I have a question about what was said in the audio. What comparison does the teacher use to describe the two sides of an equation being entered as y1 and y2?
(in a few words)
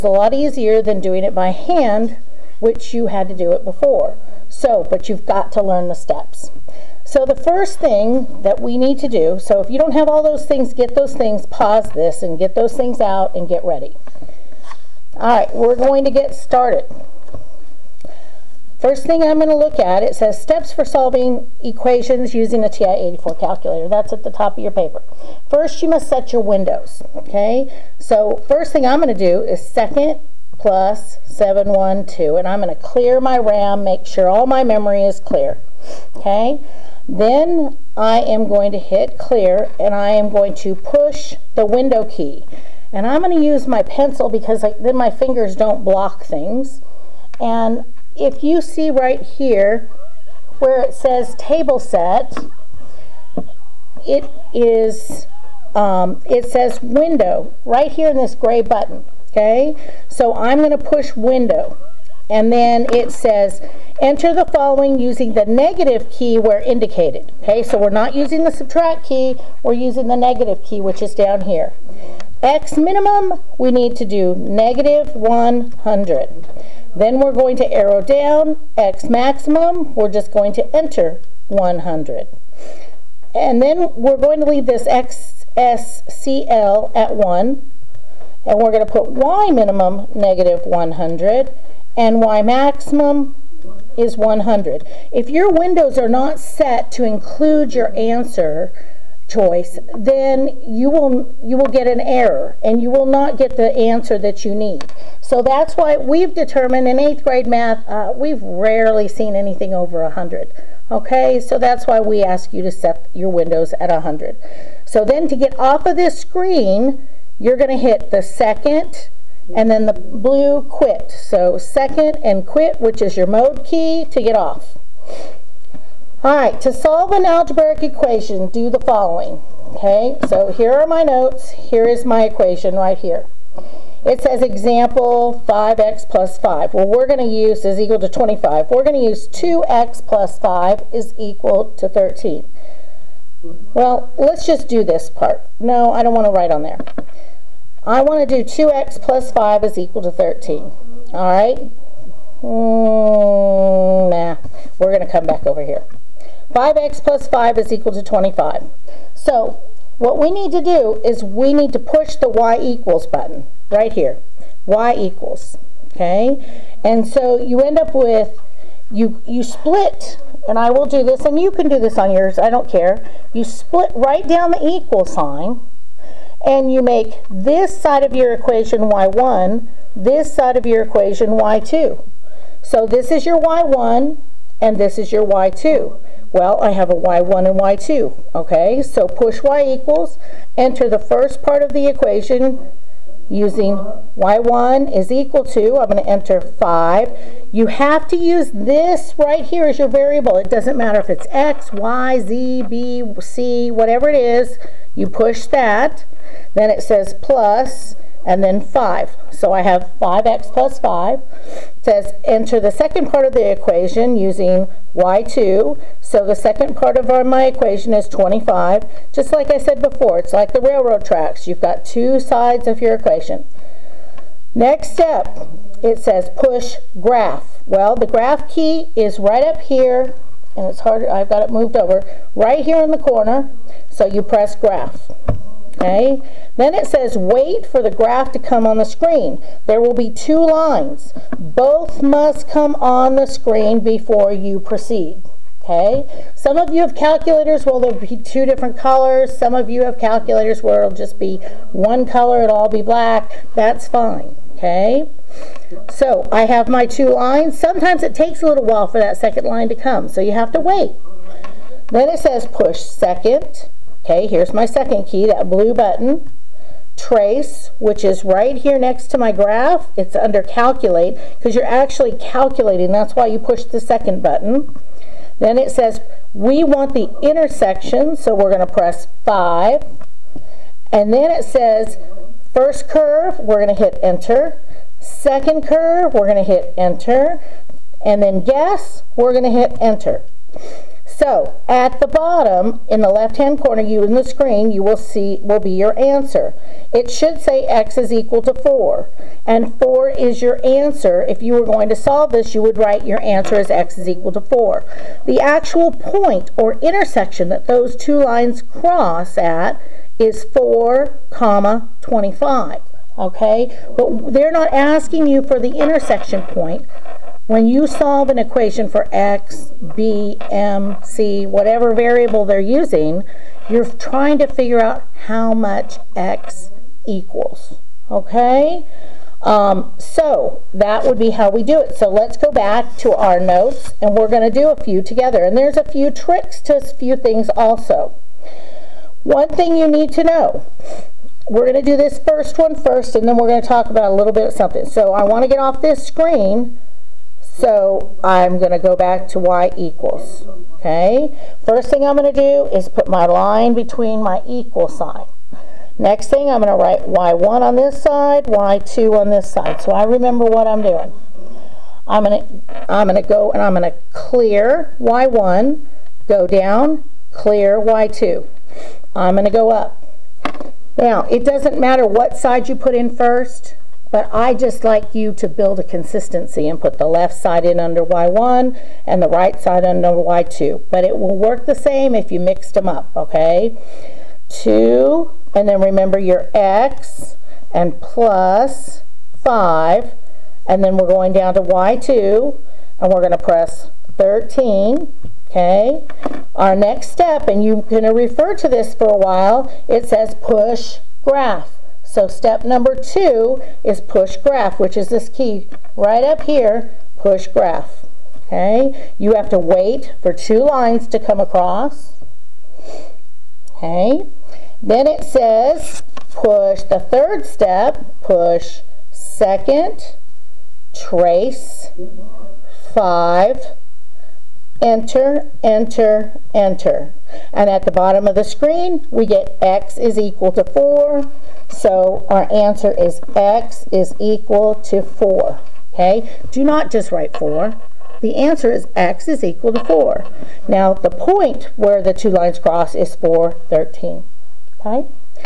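railroad tracks.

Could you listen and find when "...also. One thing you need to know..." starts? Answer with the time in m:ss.
5:37.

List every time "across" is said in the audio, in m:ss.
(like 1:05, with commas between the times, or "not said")
6:51.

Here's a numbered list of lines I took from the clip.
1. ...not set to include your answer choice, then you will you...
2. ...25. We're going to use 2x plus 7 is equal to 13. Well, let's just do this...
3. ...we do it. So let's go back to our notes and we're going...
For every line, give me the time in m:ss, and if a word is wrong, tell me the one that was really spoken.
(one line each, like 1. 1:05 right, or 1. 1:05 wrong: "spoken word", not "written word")
1. 1:36 right
2. 2:18 wrong: "5", not "7"
3. 5:31 right.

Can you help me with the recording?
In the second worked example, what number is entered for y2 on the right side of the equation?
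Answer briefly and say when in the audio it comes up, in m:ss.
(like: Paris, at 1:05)
13, at 6:33.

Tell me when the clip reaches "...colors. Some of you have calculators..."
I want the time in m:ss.
4:08.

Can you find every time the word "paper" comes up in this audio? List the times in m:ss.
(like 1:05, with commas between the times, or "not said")
0:24.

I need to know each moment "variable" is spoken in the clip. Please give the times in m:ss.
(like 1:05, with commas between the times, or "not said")
3:19, 5:21.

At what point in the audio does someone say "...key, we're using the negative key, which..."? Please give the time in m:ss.
1:09.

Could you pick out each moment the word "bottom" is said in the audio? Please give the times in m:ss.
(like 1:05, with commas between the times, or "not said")
4:52, 7:07.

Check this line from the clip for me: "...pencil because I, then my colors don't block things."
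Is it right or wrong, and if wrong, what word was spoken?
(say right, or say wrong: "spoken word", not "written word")
wrong: "fingers", not "colors".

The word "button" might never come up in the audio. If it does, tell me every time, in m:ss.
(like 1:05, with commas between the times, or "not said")
0:58, 2:43, 4:25, 4:34.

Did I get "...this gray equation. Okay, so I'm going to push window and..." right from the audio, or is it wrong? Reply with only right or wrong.
wrong.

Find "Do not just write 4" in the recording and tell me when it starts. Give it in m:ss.
7:16.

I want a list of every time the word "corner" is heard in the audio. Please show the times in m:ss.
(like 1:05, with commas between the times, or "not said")
3:52, 4:53.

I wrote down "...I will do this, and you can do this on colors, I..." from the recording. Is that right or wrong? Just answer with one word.
wrong.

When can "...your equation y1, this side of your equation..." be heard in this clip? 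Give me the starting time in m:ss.
2:58.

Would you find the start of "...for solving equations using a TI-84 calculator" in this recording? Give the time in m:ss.
0:20.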